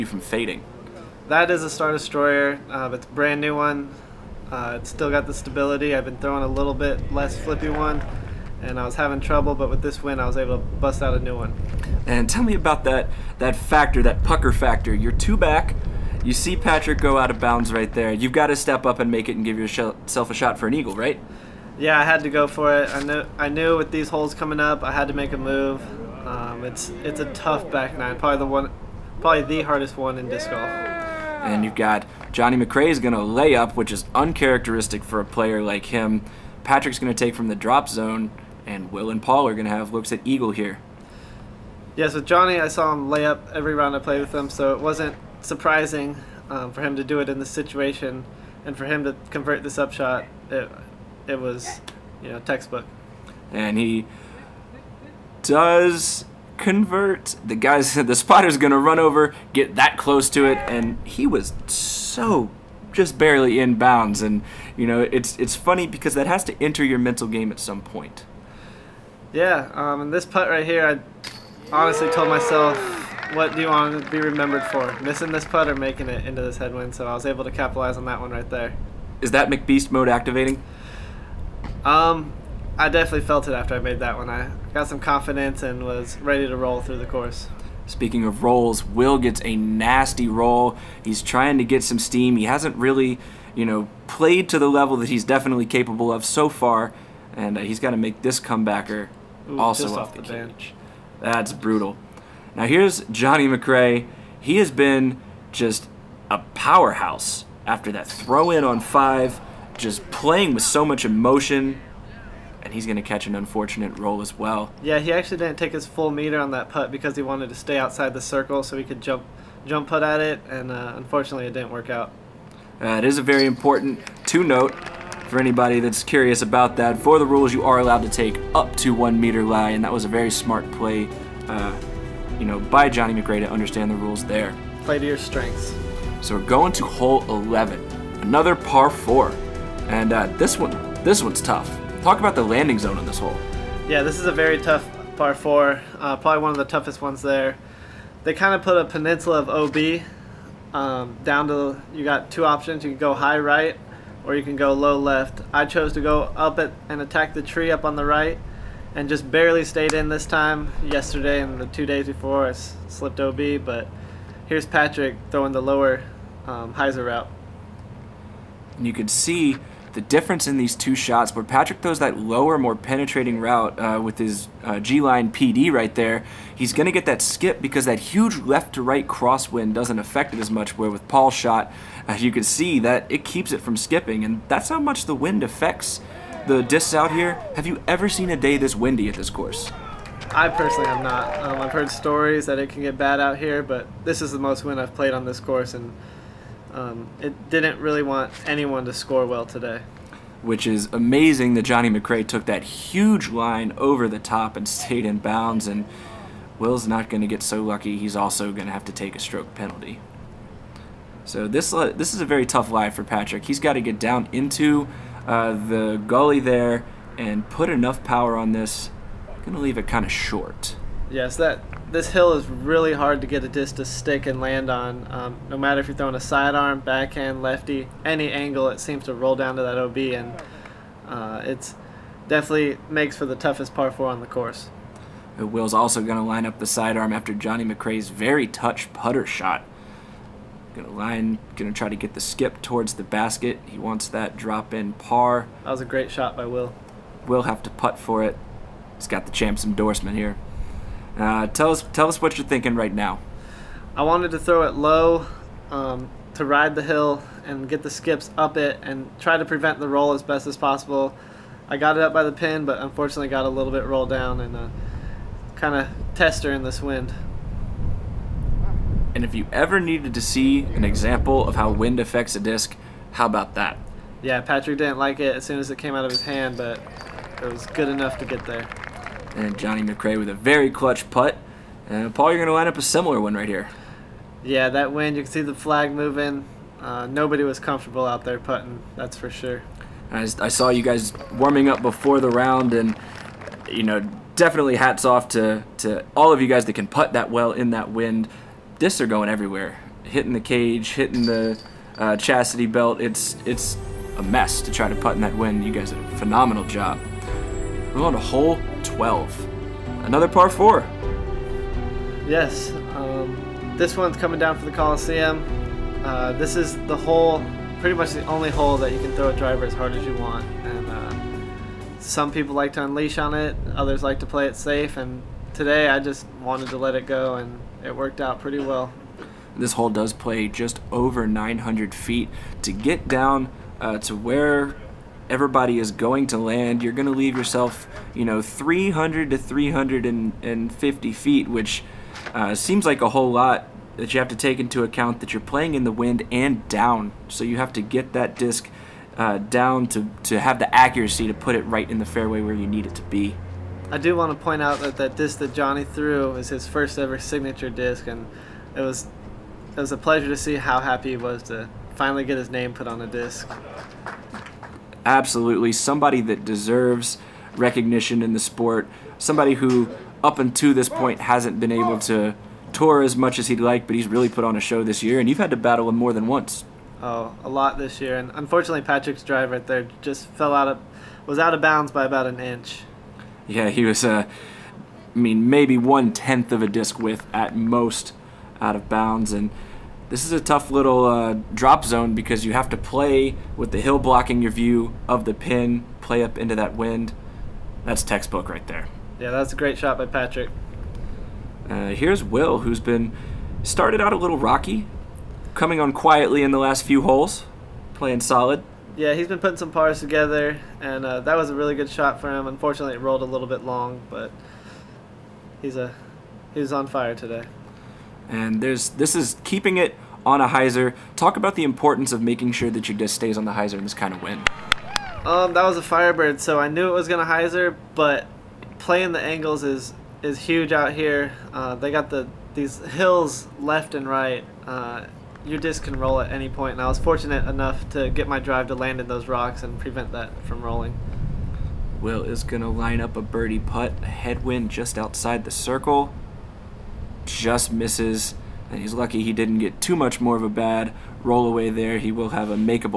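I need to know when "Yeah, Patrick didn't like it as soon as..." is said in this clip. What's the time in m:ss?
4:34.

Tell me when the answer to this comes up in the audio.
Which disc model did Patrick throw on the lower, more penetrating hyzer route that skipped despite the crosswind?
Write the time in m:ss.
2:54.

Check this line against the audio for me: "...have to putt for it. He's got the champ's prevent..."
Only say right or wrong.
wrong.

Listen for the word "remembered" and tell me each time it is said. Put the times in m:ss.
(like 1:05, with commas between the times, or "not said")
1:14.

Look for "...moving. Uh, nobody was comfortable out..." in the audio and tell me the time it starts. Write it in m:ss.
4:45.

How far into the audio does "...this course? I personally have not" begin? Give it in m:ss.
3:09.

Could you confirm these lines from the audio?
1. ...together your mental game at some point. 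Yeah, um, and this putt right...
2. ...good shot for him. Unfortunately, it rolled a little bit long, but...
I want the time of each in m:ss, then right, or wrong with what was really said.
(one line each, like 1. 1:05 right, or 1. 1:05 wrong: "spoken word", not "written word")
1. 1:06 wrong: "enter", not "together"
2. 6:51 right.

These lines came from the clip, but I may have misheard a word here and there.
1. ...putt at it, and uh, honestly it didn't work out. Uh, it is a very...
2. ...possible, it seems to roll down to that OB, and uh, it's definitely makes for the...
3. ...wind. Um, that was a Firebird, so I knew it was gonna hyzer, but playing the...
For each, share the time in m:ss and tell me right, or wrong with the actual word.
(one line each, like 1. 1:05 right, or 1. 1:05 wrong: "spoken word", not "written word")
1. 1:59 wrong: "unfortunately", not "honestly"
2. 3:48 wrong: "angle", not "possible"
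3. 7:04 right.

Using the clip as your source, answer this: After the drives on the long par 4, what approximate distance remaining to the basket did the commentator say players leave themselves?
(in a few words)
300 to 350 feet.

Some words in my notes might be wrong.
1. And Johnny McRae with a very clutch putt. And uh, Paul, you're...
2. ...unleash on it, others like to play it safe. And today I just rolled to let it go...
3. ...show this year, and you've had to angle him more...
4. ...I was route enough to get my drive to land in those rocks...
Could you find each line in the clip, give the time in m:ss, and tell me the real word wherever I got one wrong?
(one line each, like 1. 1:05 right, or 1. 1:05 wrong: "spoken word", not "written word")
1. 4:39 right
2. 5:22 wrong: "wanted", not "rolled"
3. 6:14 wrong: "battle", not "angle"
4. 7:16 wrong: "fortunate", not "route".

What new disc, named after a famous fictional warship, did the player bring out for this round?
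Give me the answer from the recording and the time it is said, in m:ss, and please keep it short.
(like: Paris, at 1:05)
Star Destroyer, at 0:01.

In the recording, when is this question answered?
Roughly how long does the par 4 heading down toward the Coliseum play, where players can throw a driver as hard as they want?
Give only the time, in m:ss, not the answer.
5:30.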